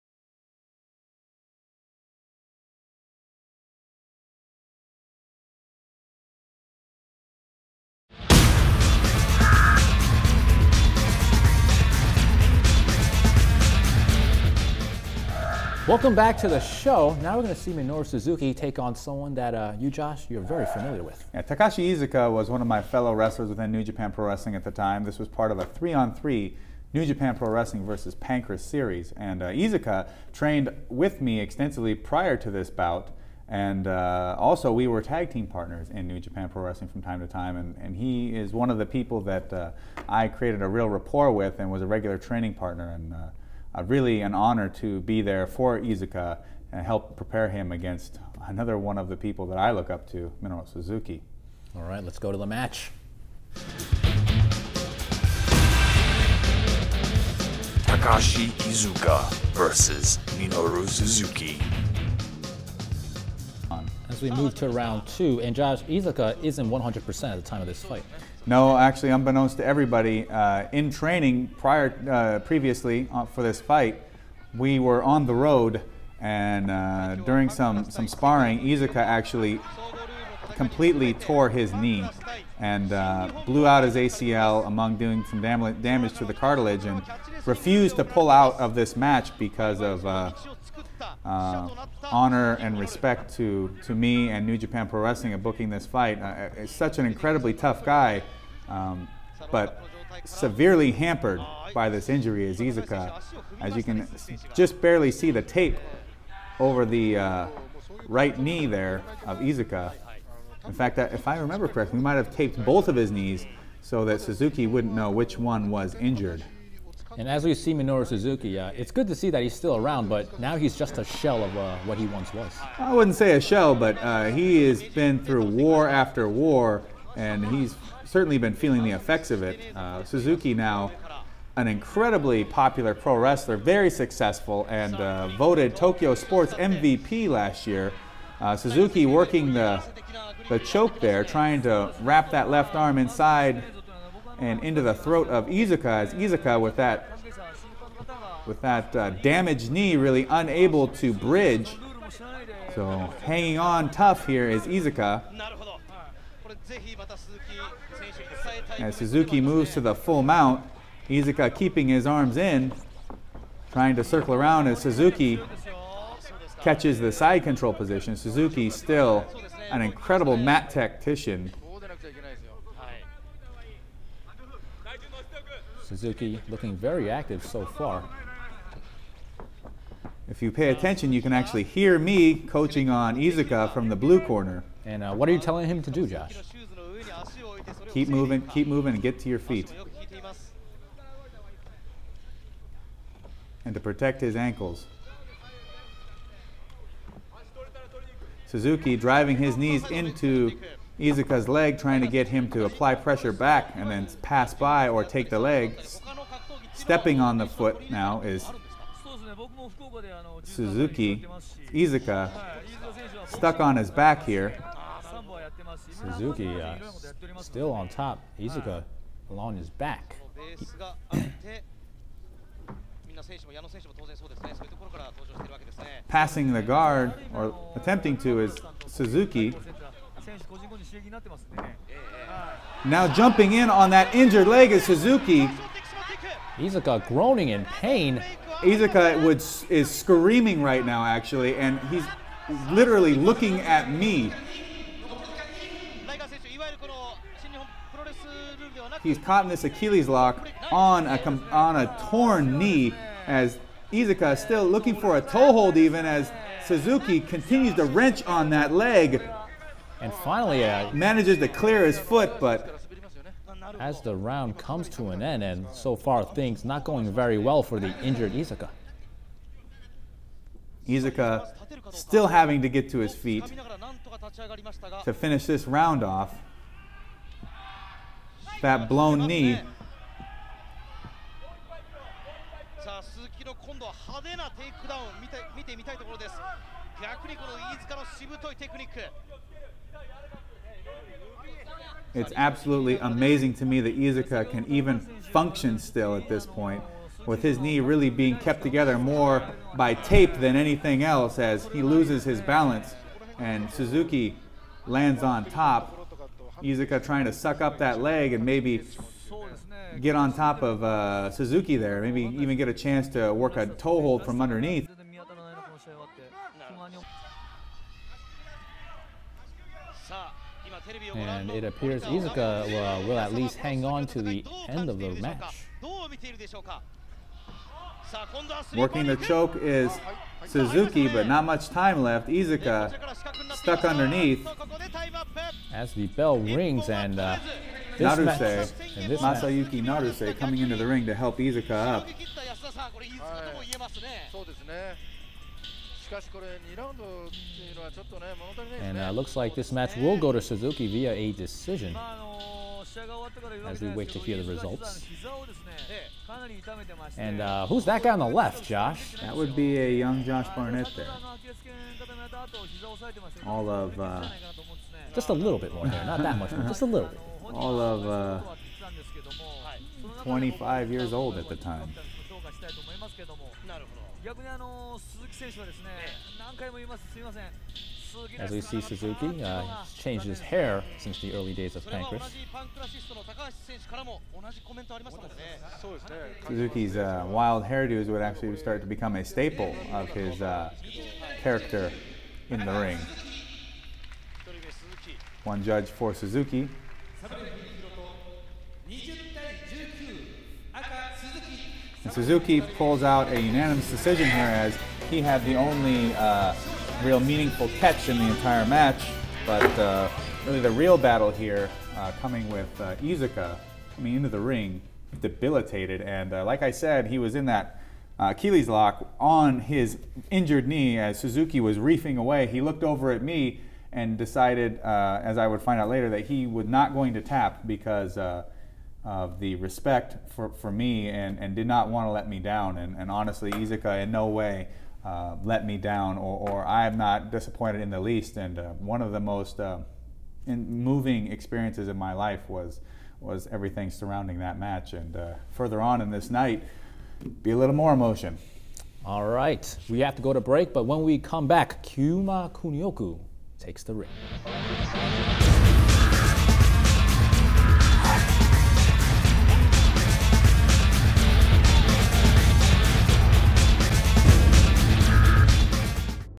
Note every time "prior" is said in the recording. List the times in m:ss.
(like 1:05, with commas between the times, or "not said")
0:31, 1:11.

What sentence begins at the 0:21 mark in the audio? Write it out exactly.
Yeah, Takashi Iizuka was one of my fellow wrestlers within New Japan Pro Wrestling at the time.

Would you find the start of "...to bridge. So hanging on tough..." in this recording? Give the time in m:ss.
2:30.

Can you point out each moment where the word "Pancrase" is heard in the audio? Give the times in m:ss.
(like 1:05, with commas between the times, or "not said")
0:28, 6:21.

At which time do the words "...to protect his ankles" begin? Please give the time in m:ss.
3:13.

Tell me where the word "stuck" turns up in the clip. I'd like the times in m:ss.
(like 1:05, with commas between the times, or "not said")
3:33, 5:33.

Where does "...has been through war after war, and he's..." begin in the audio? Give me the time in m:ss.
2:04.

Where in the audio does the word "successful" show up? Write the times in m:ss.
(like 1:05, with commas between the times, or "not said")
2:13.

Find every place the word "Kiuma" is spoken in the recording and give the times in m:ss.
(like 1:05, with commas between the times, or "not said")
7:31.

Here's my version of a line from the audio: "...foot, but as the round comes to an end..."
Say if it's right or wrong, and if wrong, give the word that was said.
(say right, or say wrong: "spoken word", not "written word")
right.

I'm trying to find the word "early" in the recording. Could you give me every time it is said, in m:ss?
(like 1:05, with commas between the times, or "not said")
6:21.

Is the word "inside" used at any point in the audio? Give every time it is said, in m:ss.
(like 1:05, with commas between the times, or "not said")
2:22.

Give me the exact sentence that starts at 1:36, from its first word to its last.
Uh, uh such an incredibly tough guy, um, but severely hampered by this injury is Iizuka.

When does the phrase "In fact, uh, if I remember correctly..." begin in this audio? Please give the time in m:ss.
1:50.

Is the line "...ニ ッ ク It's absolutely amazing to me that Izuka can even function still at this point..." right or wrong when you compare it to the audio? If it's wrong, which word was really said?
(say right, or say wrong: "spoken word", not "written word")
right.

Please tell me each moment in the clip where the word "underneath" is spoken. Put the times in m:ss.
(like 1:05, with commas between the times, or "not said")
5:14, 5:33.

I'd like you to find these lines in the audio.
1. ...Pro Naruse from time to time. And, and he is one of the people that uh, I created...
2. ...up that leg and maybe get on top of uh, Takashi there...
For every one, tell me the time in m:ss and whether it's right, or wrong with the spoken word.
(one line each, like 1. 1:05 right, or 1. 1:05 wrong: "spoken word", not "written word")
1. 0:36 wrong: "Wrestling", not "Naruse"
2. 5:07 wrong: "Suzuki", not "Takashi".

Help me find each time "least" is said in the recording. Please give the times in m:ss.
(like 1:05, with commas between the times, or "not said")
5:23, 7:17.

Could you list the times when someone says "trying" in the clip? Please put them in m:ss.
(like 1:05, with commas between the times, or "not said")
2:21, 2:43, 3:21, 5:07.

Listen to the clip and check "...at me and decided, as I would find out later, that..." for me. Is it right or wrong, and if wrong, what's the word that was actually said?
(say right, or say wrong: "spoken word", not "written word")
right.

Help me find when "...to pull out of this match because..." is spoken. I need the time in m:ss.
1:27.